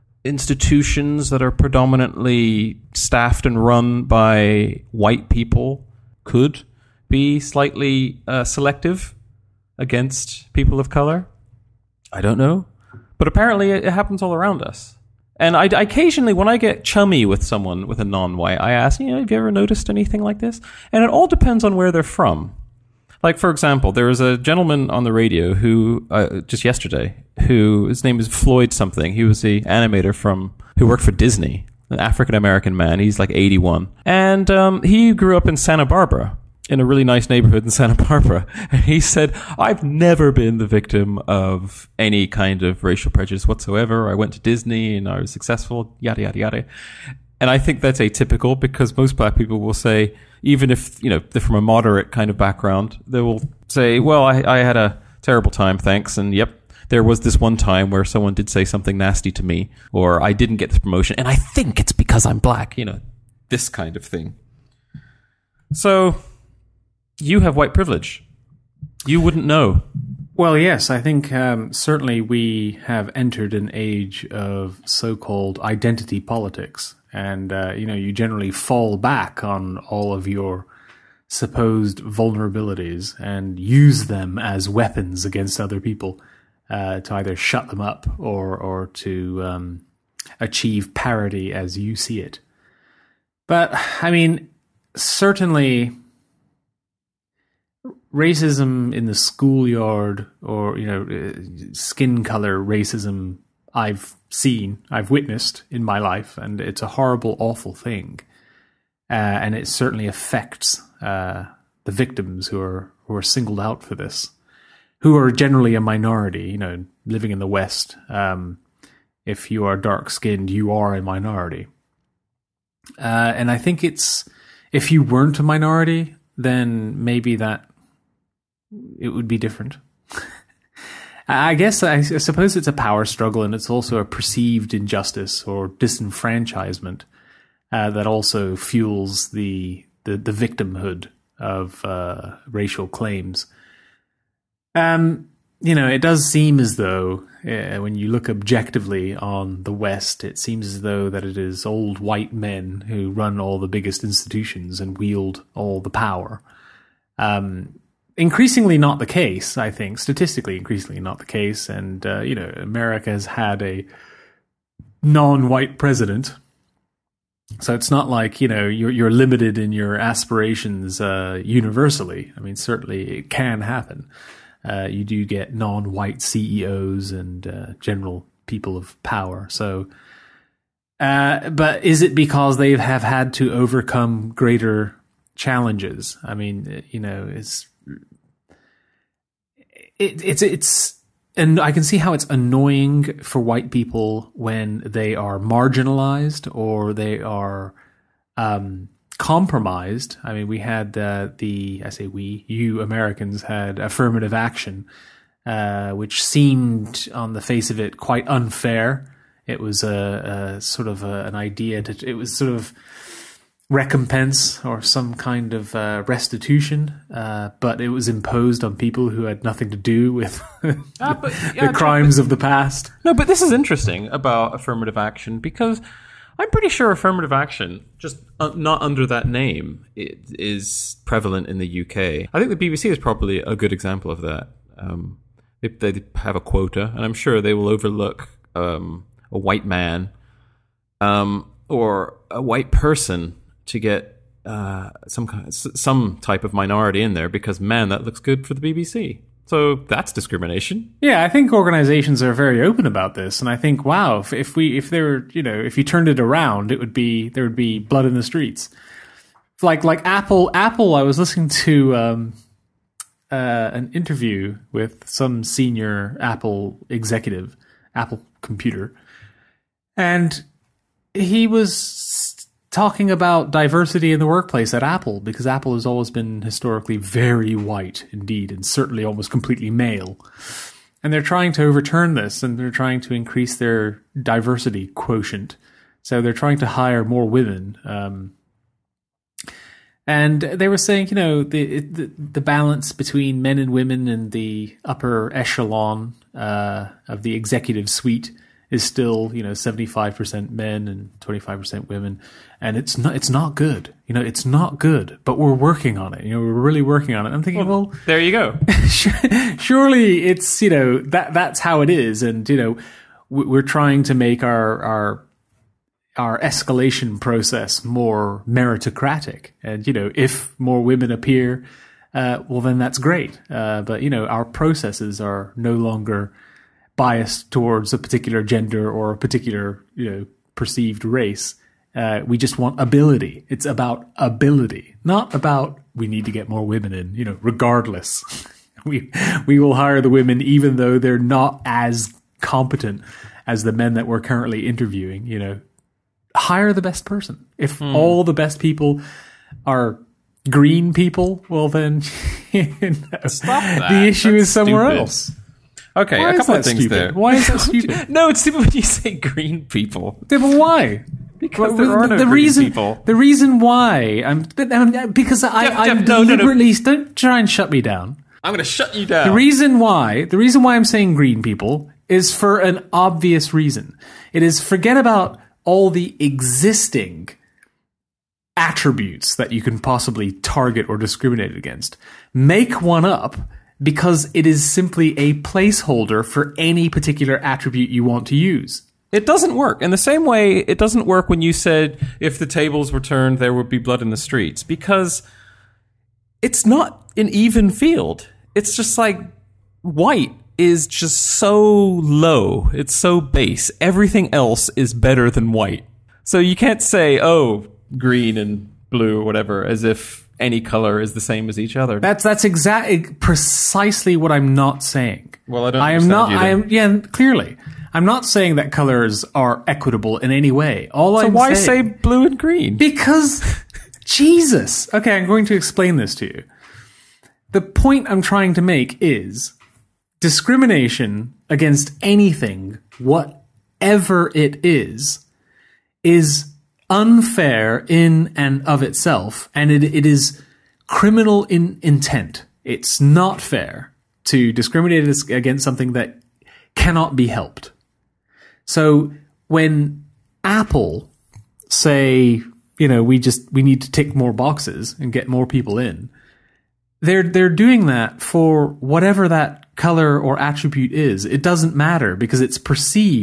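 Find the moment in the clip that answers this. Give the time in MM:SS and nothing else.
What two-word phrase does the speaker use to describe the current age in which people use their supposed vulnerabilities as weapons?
01:15.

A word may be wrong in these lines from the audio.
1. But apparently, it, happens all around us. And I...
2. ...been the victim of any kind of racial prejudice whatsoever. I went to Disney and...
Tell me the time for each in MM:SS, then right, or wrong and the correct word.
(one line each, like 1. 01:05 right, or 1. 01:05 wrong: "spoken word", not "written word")
1. 00:13 right
2. 00:40 right.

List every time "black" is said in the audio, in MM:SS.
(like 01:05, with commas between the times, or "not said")
00:49, 01:02.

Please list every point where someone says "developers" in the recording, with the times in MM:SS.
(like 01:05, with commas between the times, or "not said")
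not said.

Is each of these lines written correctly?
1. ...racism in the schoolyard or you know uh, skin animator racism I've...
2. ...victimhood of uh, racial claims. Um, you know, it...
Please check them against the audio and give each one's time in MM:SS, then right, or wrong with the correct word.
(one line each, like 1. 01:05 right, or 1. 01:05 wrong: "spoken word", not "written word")
1. 01:38 wrong: "color", not "animator"
2. 02:20 right.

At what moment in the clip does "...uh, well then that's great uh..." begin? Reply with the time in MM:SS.
05:22.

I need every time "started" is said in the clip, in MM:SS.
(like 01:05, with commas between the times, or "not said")
not said.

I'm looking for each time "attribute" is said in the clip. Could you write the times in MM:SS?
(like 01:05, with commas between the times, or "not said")
06:18, 06:27, 07:40.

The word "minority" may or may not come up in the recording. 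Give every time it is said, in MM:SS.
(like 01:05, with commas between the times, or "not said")
01:55, 02:01, 02:05, 04:06.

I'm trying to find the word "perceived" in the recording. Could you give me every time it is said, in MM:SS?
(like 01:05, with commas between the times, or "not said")
02:14, 05:30, 07:42.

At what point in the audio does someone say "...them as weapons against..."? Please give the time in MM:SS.
01:24.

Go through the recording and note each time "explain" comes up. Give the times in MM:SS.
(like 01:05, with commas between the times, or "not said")
07:05.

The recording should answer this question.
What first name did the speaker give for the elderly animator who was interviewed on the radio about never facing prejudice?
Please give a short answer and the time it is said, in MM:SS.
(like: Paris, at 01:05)
Floyd, at 00:28.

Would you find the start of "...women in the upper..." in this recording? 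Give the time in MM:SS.
04:53.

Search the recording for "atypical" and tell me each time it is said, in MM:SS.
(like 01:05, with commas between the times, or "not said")
00:47.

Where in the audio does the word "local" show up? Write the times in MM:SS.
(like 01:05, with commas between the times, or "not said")
not said.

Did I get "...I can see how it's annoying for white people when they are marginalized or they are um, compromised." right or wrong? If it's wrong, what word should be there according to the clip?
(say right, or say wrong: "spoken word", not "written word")
right.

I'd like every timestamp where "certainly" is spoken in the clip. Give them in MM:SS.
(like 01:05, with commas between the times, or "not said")
01:11, 01:34, 01:49, 02:52, 04:38.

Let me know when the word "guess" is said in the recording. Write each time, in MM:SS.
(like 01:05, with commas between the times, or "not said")
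02:11.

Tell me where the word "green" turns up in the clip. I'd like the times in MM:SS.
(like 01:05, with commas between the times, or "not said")
05:50, 05:59, 06:11, 06:47, 07:02.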